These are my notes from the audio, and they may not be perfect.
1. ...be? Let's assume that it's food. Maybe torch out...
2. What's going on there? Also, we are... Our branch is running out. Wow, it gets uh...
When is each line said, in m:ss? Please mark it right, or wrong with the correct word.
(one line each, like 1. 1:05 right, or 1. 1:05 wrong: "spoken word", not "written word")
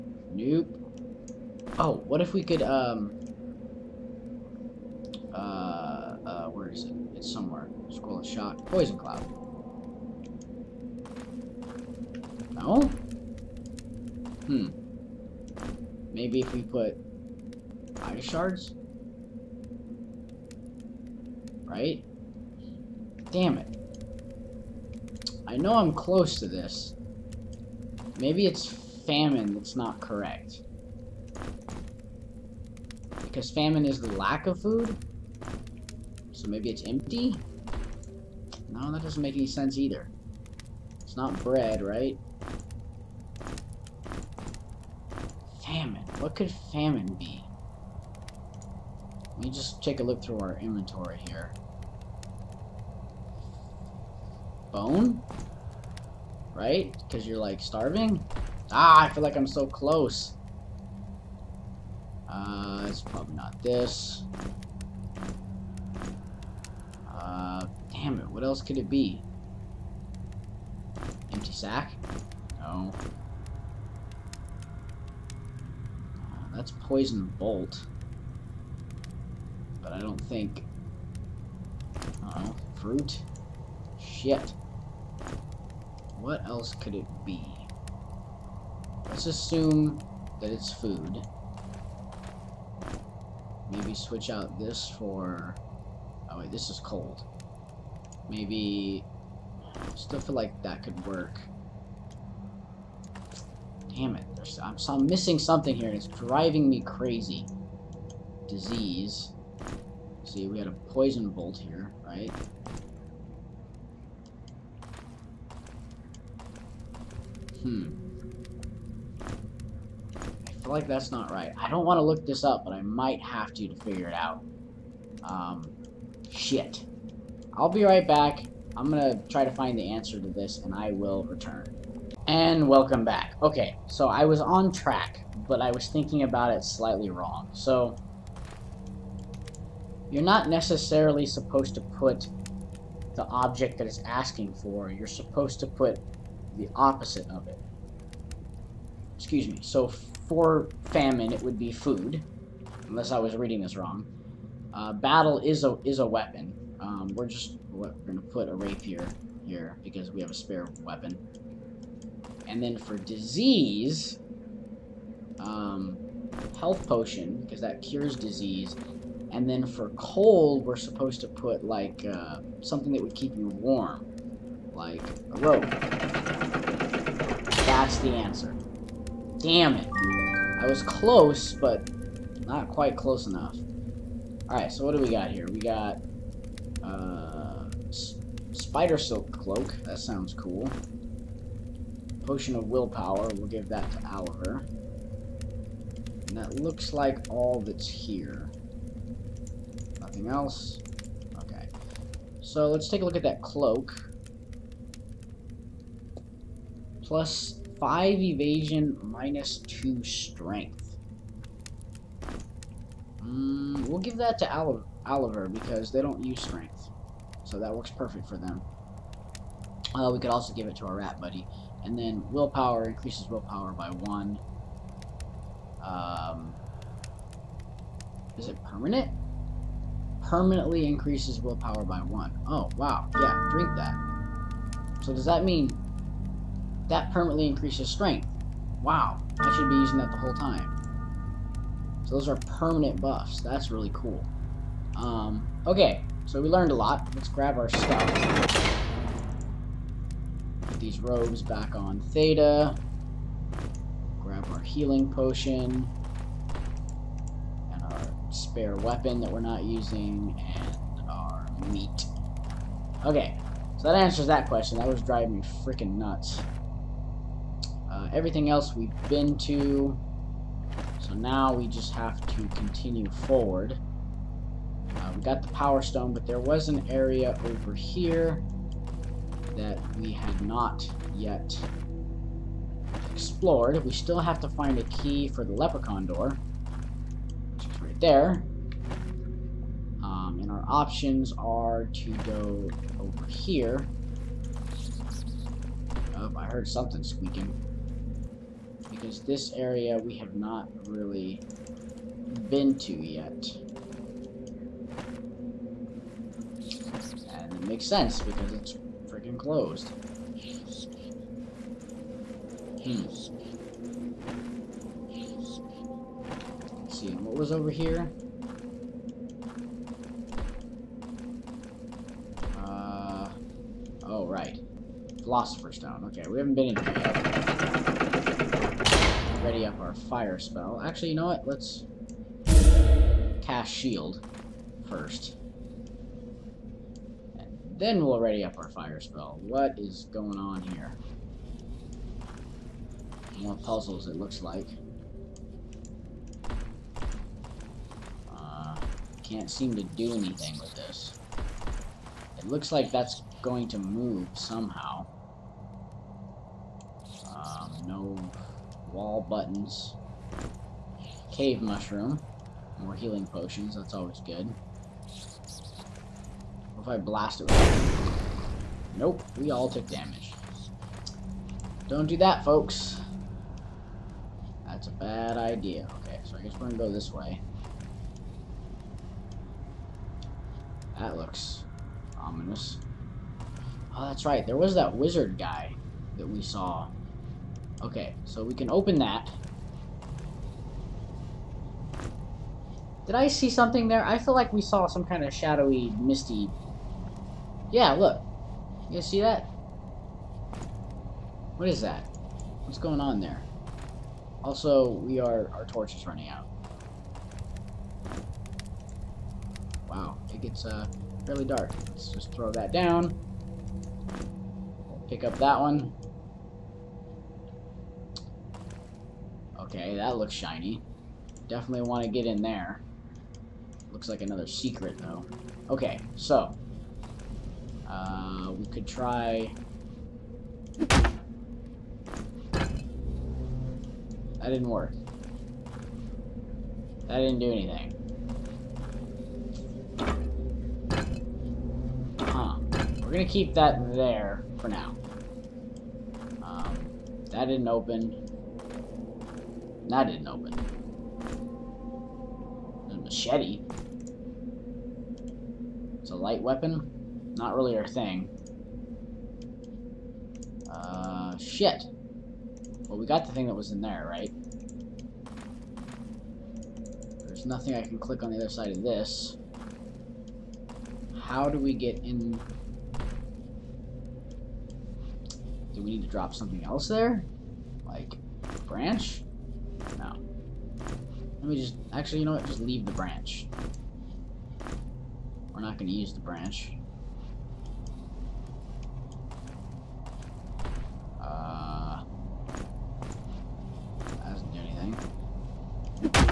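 1. 1:27 wrong: "switch", not "torch"
2. 6:42 wrong: "torch", not "branch".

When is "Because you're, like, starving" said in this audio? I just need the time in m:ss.
0:57.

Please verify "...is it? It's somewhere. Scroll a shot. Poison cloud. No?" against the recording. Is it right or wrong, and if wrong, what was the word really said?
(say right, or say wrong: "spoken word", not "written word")
right.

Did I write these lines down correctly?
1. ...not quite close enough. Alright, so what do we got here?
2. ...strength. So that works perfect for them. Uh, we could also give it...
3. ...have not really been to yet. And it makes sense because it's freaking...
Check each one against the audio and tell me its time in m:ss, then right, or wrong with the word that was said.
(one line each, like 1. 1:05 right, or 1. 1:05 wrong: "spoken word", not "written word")
1. 3:02 right
2. 3:36 right
3. 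5:00 right.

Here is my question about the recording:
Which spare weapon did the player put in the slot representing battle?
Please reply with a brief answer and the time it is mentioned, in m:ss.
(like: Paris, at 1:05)
rapier, at 2:38.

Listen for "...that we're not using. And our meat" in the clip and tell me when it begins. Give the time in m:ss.
4:19.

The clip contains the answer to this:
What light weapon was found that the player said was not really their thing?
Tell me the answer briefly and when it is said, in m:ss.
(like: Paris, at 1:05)
machete, at 7:32.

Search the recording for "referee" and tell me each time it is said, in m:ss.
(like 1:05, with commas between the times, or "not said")
not said.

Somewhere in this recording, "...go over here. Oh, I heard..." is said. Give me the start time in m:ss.
4:52.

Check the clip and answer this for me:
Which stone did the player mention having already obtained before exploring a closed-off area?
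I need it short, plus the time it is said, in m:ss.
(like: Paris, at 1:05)
Power Stone, at 4:35.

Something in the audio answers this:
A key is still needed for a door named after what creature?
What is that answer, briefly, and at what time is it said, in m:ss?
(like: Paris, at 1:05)
Leprechaun, at 4:45.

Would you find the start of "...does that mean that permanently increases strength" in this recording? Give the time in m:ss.
3:55.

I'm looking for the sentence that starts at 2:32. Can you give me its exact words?
Unless I was reading this wrong.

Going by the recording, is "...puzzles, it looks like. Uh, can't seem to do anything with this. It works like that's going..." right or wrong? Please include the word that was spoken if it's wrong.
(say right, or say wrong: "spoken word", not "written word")
wrong: "looks", not "works".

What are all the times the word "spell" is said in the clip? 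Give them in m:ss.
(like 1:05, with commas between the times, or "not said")
5:30, 5:39.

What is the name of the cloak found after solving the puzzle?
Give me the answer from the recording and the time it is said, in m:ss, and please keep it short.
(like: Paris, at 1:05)
Spider Silk Cloak, at 3:08.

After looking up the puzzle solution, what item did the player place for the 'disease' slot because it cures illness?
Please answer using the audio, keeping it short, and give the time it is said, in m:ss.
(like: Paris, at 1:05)
health potion, at 2:46.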